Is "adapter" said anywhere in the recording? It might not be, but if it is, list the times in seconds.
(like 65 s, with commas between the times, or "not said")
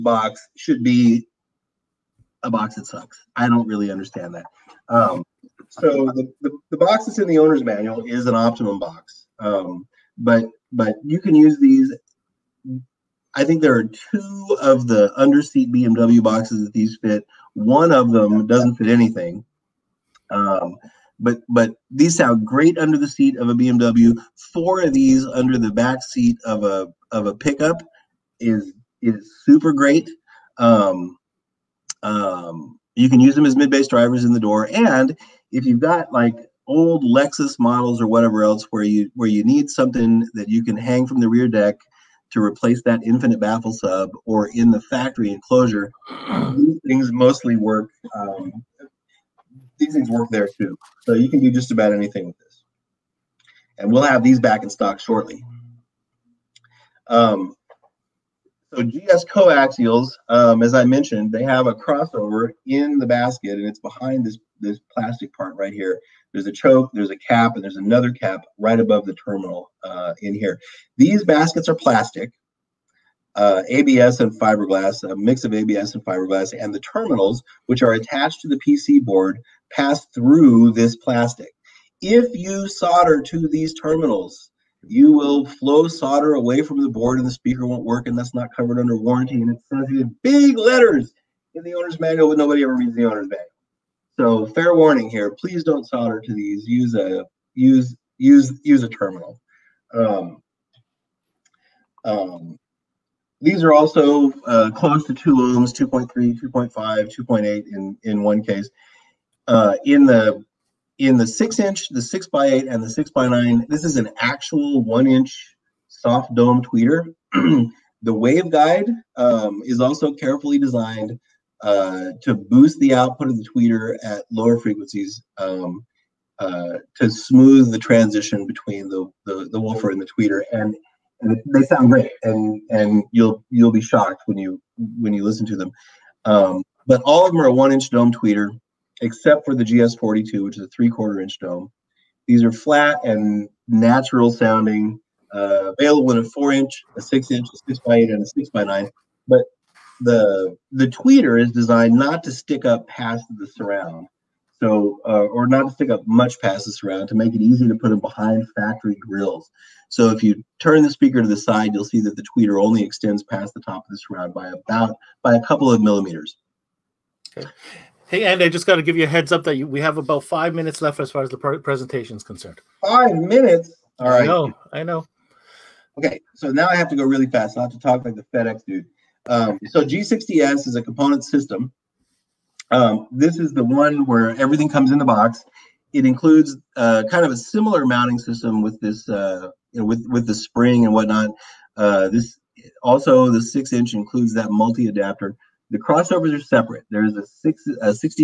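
194 s.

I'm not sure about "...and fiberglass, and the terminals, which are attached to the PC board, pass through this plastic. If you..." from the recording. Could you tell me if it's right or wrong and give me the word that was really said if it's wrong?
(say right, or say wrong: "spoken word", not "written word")
right.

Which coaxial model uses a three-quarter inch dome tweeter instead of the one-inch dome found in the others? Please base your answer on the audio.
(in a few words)
GS42.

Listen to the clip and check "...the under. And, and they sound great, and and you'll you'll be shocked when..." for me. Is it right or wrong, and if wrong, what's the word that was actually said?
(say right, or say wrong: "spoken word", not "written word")
wrong: "tweeter", not "under".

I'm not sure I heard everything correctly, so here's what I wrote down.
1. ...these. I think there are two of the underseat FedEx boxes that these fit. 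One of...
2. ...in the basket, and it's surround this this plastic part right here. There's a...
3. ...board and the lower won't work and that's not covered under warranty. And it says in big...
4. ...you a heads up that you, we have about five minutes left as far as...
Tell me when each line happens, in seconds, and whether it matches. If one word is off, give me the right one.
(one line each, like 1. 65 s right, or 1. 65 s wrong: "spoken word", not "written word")
1. 11 s wrong: "BMW", not "FedEx"
2. 62 s wrong: "behind", not "surround"
3. 86 s wrong: "speaker", not "lower"
4. 168 s right.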